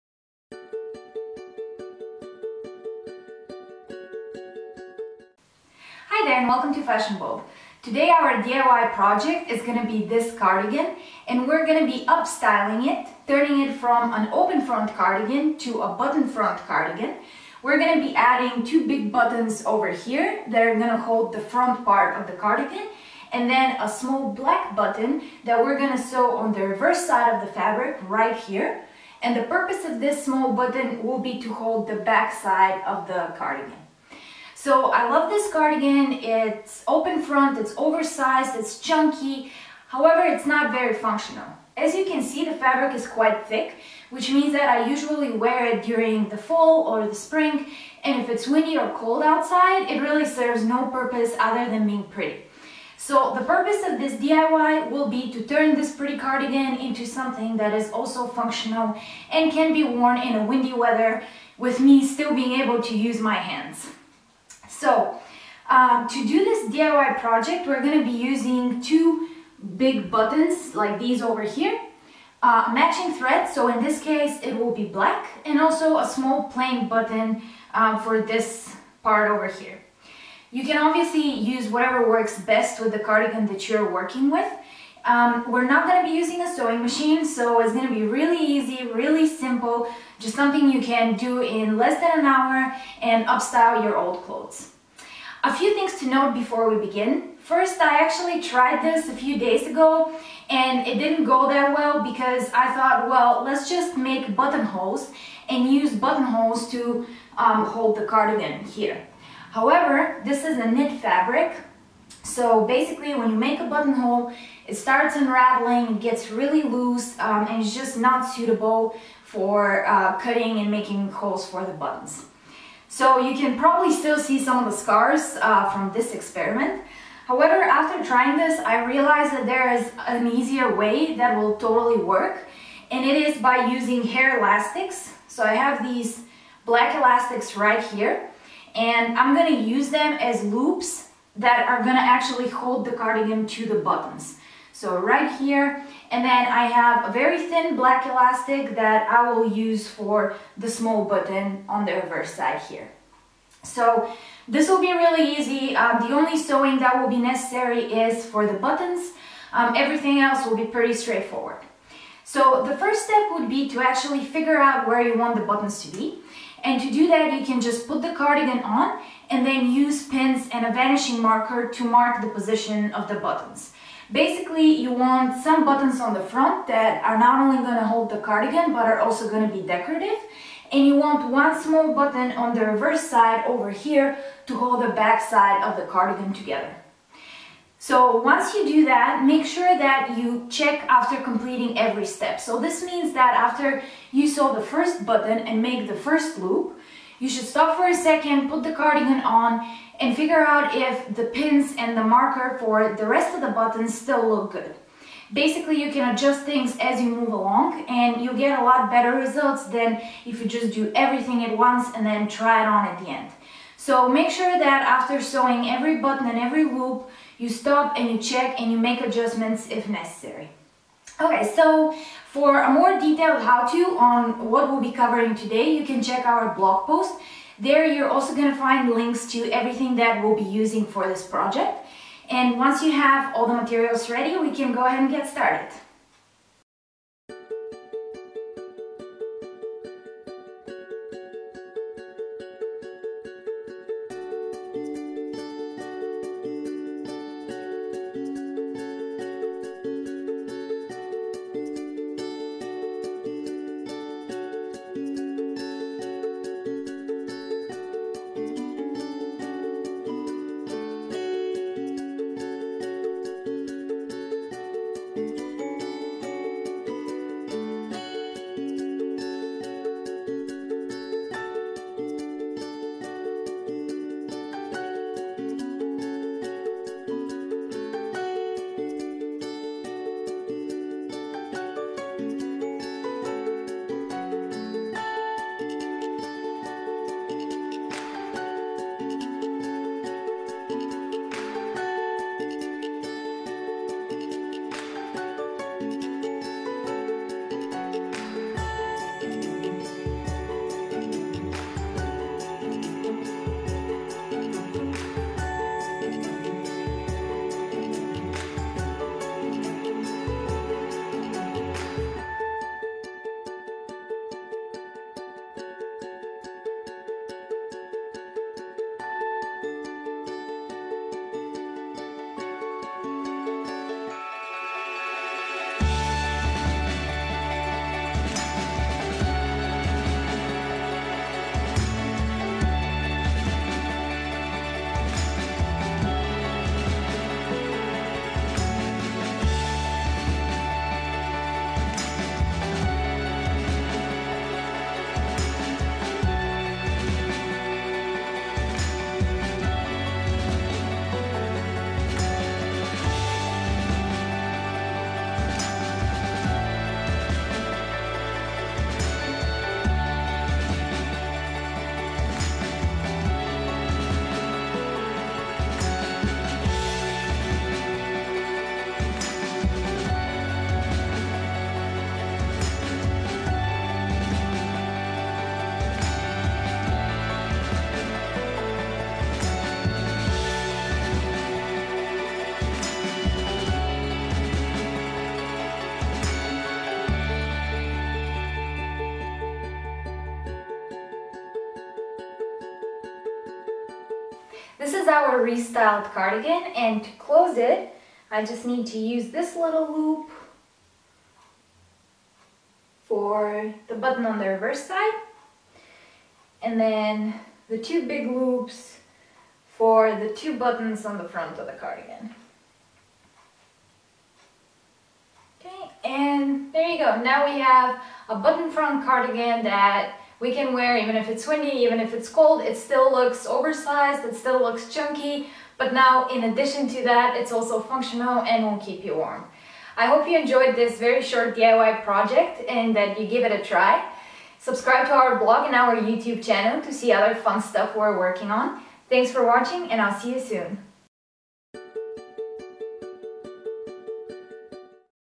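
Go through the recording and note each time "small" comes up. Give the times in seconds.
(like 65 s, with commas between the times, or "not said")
23 s, 30 s, 76 s, 150 s, 181 s.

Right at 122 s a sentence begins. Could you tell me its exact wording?
So you can probably still see some of the scars uh, from this experiment.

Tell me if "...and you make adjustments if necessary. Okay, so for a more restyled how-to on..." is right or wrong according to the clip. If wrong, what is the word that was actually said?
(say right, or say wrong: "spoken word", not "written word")
wrong: "detailed", not "restyled".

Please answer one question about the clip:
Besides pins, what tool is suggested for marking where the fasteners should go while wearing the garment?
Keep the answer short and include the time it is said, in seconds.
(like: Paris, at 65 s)
vanishing marker, at 170 s.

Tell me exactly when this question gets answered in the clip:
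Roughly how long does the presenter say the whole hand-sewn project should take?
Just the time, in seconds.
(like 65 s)
91 s.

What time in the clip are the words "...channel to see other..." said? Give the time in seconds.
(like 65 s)
436 s.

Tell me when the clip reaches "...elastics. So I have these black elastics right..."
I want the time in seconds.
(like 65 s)
134 s.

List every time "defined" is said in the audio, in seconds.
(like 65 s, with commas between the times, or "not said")
not said.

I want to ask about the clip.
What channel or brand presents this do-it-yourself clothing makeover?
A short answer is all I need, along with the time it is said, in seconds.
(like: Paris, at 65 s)
Fashion Bulb, at 6 s.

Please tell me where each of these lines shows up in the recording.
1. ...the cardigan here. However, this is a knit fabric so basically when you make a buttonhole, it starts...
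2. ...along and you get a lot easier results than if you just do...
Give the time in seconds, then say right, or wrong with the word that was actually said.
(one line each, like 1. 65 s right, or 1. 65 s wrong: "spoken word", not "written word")
1. 107 s right
2. 207 s wrong: "better", not "easier".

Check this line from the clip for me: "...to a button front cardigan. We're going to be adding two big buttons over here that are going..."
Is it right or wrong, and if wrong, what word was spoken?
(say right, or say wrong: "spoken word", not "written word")
right.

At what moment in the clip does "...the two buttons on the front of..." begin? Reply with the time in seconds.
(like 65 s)
410 s.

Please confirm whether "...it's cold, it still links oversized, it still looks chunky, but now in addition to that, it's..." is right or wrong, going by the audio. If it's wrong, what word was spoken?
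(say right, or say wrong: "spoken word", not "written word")
wrong: "looks", not "links".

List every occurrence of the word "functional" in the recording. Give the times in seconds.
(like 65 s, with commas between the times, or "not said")
40 s, 58 s, 427 s.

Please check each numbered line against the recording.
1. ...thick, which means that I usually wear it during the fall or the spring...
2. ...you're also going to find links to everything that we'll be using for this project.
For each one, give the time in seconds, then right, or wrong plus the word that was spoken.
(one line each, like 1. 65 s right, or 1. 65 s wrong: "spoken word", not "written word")
1. 43 s right
2. 227 s right.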